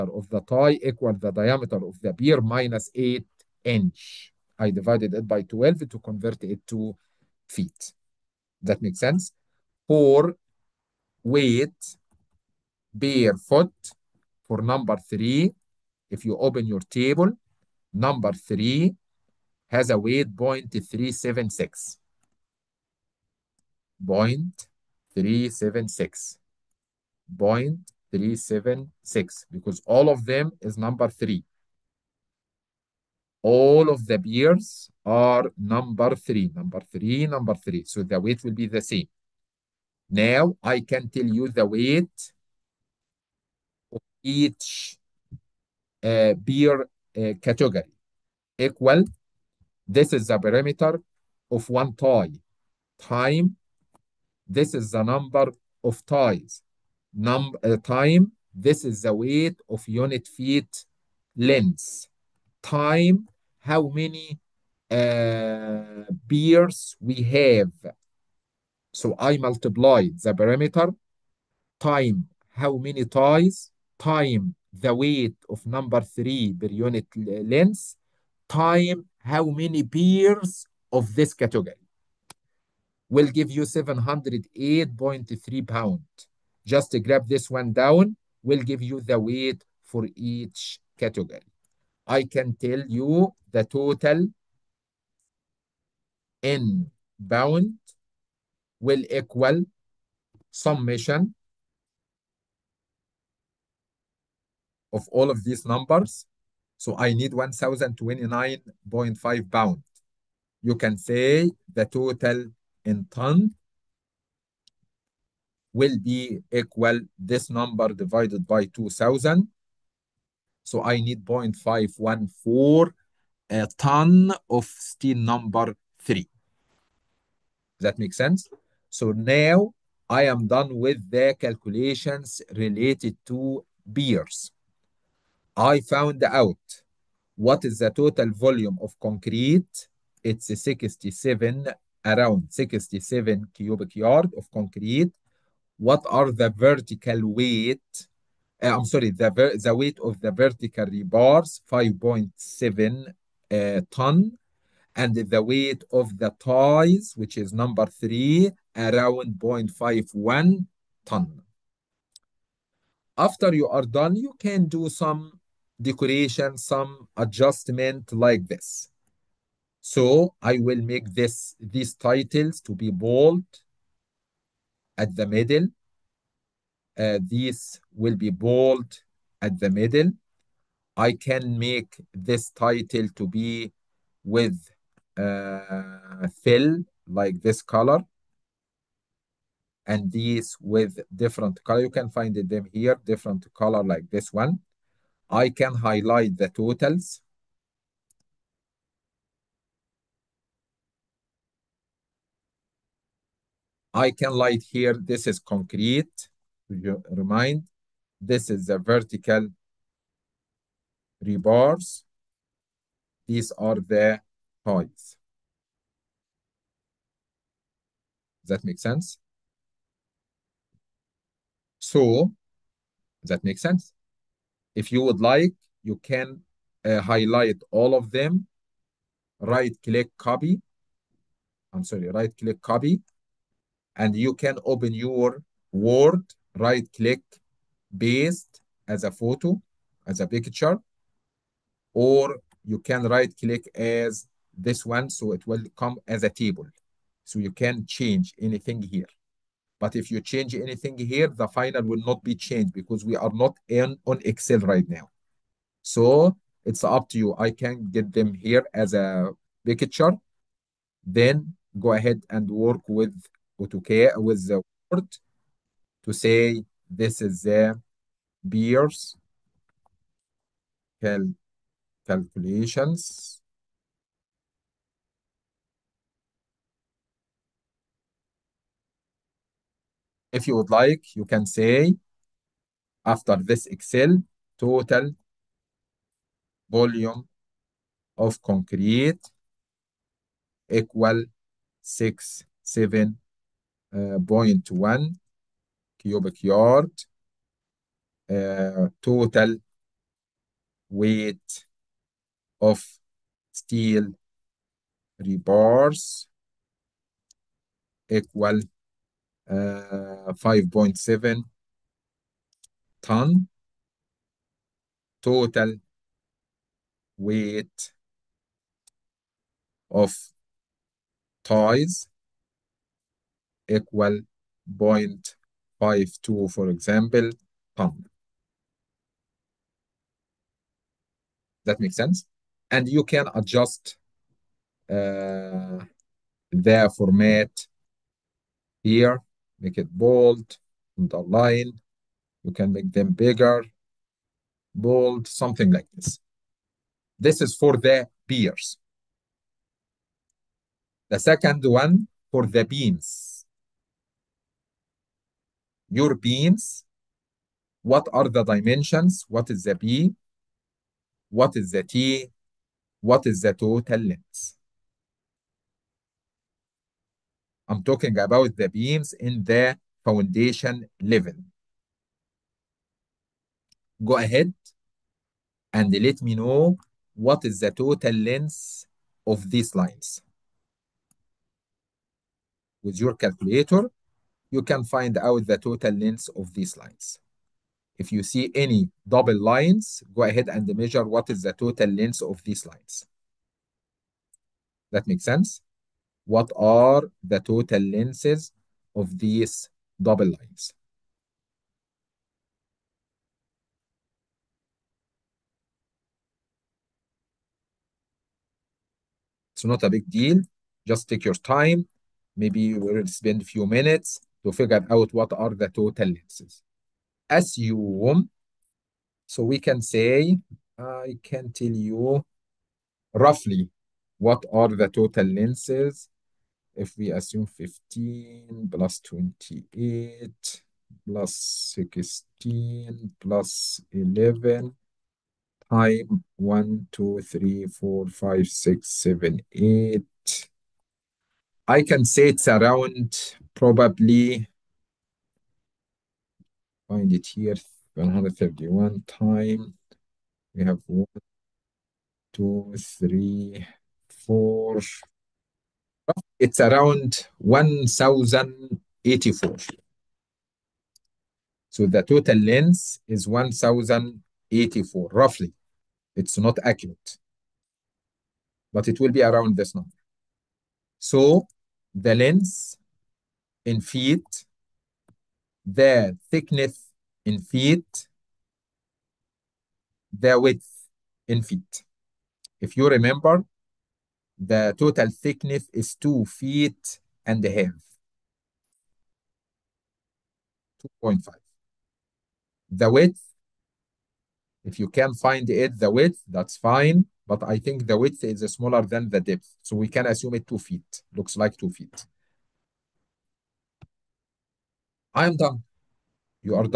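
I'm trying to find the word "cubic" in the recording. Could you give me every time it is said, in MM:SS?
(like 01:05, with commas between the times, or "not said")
02:23, 04:55.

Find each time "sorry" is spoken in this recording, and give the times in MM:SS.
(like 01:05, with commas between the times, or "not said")
02:28, 03:51.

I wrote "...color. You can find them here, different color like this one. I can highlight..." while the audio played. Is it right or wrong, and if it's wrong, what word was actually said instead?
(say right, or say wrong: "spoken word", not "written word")
right.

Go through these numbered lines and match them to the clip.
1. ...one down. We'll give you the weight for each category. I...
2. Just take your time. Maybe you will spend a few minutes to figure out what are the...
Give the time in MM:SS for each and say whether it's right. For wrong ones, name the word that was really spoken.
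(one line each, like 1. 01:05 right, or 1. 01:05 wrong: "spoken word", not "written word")
1. 01:27 right
2. 06:50 right.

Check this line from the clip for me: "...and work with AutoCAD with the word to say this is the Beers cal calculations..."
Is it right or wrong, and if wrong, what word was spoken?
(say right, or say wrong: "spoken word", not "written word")
right.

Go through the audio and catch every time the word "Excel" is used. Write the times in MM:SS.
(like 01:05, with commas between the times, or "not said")
04:14, 04:43.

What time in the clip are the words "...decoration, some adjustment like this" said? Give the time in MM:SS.
02:45.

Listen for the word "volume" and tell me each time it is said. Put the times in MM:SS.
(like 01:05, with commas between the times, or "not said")
02:18, 04:46.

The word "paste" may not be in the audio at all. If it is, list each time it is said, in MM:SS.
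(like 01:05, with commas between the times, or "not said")
03:58.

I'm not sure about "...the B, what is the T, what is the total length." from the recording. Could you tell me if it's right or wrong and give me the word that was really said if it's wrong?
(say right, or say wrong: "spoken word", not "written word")
right.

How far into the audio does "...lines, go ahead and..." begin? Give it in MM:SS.
06:29.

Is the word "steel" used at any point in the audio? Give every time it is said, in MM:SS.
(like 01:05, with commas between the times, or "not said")
02:04, 05:03.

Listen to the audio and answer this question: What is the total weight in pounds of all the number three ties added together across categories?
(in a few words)
1,029.5 pounds.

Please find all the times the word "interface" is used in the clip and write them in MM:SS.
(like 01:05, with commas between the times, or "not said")
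not said.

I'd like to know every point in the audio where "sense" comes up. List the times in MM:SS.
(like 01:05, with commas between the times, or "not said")
00:08, 02:08, 03:38, 03:43, 05:31, 06:35.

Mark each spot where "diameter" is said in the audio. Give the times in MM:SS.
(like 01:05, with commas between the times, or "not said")
00:01.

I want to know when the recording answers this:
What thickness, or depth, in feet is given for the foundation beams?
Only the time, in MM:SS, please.
08:11.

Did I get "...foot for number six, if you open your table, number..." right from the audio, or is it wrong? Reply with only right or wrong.
wrong.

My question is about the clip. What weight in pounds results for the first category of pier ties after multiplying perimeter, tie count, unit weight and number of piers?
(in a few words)
708.3 pounds.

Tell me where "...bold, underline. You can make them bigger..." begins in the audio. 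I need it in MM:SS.
05:39.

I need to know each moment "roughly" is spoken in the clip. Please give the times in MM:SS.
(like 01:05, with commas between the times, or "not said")
07:03, 07:45.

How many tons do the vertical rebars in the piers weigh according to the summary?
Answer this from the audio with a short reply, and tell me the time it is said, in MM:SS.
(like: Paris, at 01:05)
5.7 tons, at 02:31.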